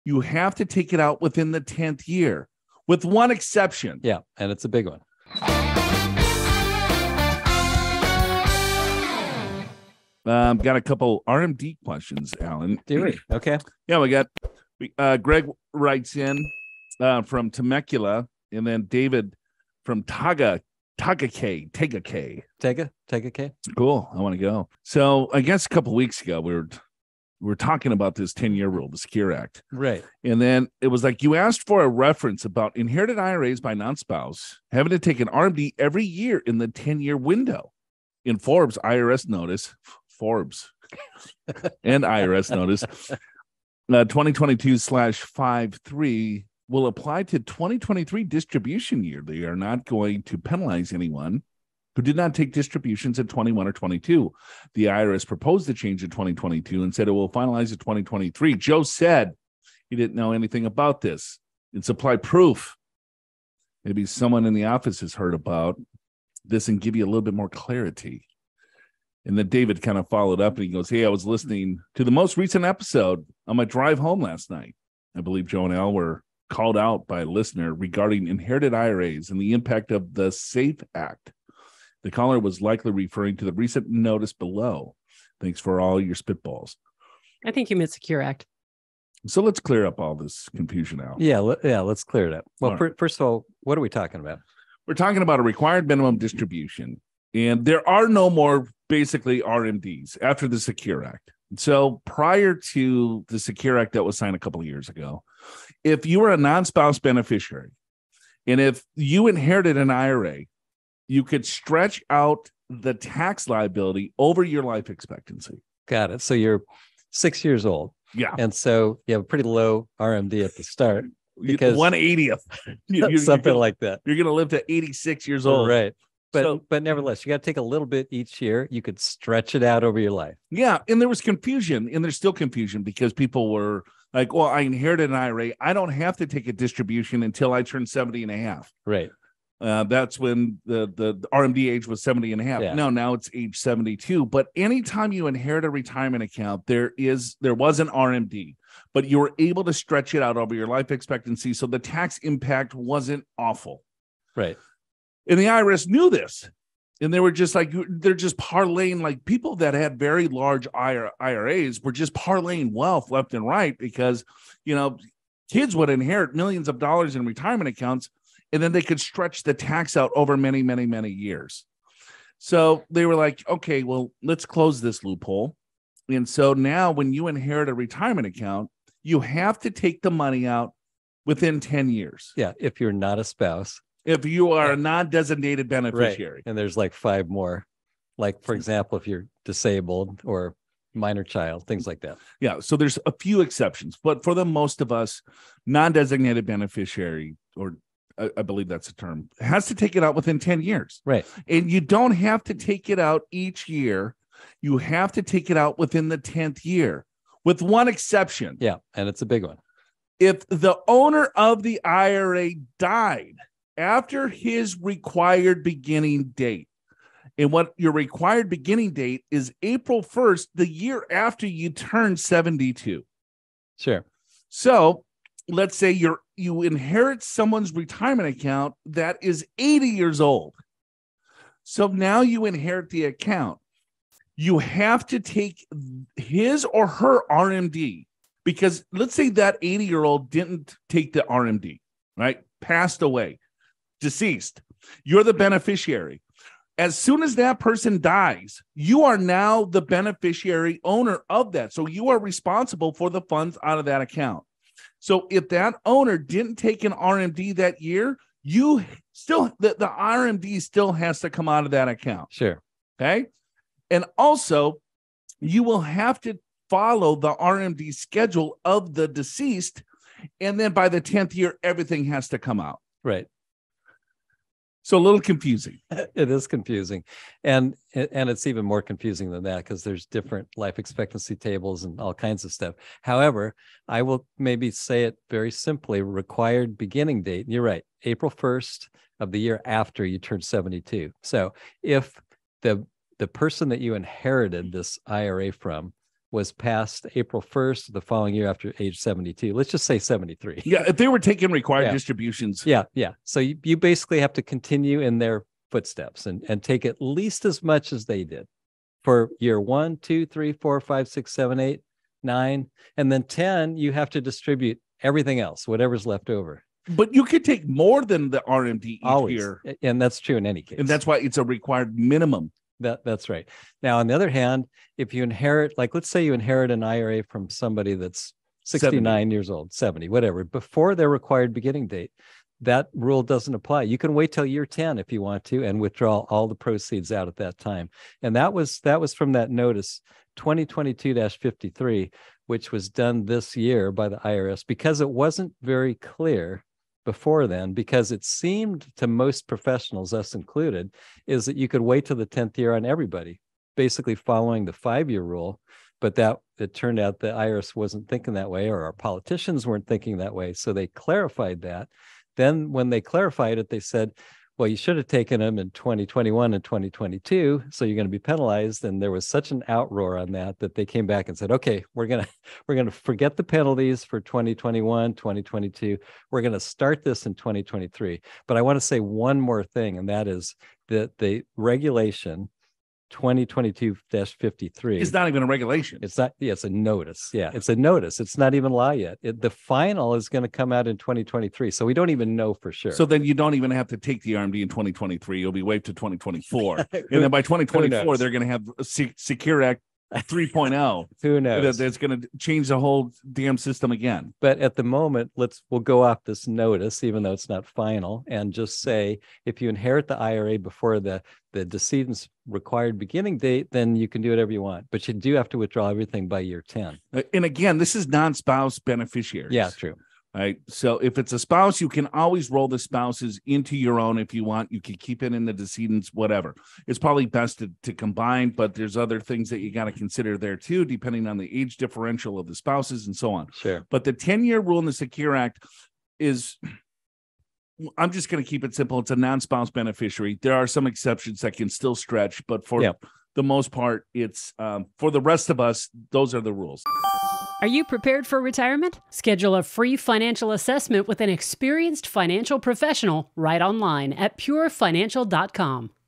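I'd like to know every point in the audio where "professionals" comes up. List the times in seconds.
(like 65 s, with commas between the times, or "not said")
349 s, 452 s.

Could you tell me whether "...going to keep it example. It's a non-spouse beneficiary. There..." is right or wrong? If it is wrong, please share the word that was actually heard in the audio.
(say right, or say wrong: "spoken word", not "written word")
wrong: "simple", not "example".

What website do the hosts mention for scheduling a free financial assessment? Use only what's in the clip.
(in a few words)
purefinancial.com.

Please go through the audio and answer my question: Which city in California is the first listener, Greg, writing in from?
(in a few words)
Temecula.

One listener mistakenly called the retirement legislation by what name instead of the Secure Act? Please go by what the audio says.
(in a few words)
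SAFE Act.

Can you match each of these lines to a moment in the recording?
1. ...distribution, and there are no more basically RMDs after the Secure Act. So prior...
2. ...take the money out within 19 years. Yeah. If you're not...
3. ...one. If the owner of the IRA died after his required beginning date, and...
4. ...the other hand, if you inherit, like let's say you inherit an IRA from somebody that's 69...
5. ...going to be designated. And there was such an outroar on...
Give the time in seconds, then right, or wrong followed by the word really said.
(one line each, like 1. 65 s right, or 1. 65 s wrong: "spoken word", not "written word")
1. 96 s right
2. 179 s wrong: "10", not "19"
3. 209 s right
4. 324 s right
5. 367 s wrong: "penalized", not "designated".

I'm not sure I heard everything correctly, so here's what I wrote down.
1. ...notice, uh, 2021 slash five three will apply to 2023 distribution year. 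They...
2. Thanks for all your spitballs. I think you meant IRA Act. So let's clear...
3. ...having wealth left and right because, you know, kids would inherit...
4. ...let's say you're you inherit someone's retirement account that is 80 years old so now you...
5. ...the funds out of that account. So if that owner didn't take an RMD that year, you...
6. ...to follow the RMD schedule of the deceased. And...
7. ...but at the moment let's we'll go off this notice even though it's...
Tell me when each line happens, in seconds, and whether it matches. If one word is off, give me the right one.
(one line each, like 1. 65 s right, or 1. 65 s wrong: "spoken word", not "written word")
1. 42 s wrong: "2022", not "2021"
2. 85 s wrong: "Secure", not "IRA"
3. 162 s wrong: "parlaying", not "having"
4. 225 s right
5. 253 s right
6. 266 s right
7. 404 s right.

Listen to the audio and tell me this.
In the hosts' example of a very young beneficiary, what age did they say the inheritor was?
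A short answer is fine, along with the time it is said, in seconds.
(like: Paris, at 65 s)
6, at 117 s.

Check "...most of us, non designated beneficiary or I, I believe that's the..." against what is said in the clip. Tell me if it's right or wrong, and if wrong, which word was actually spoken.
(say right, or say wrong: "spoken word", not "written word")
right.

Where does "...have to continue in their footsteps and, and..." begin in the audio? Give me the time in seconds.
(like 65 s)
304 s.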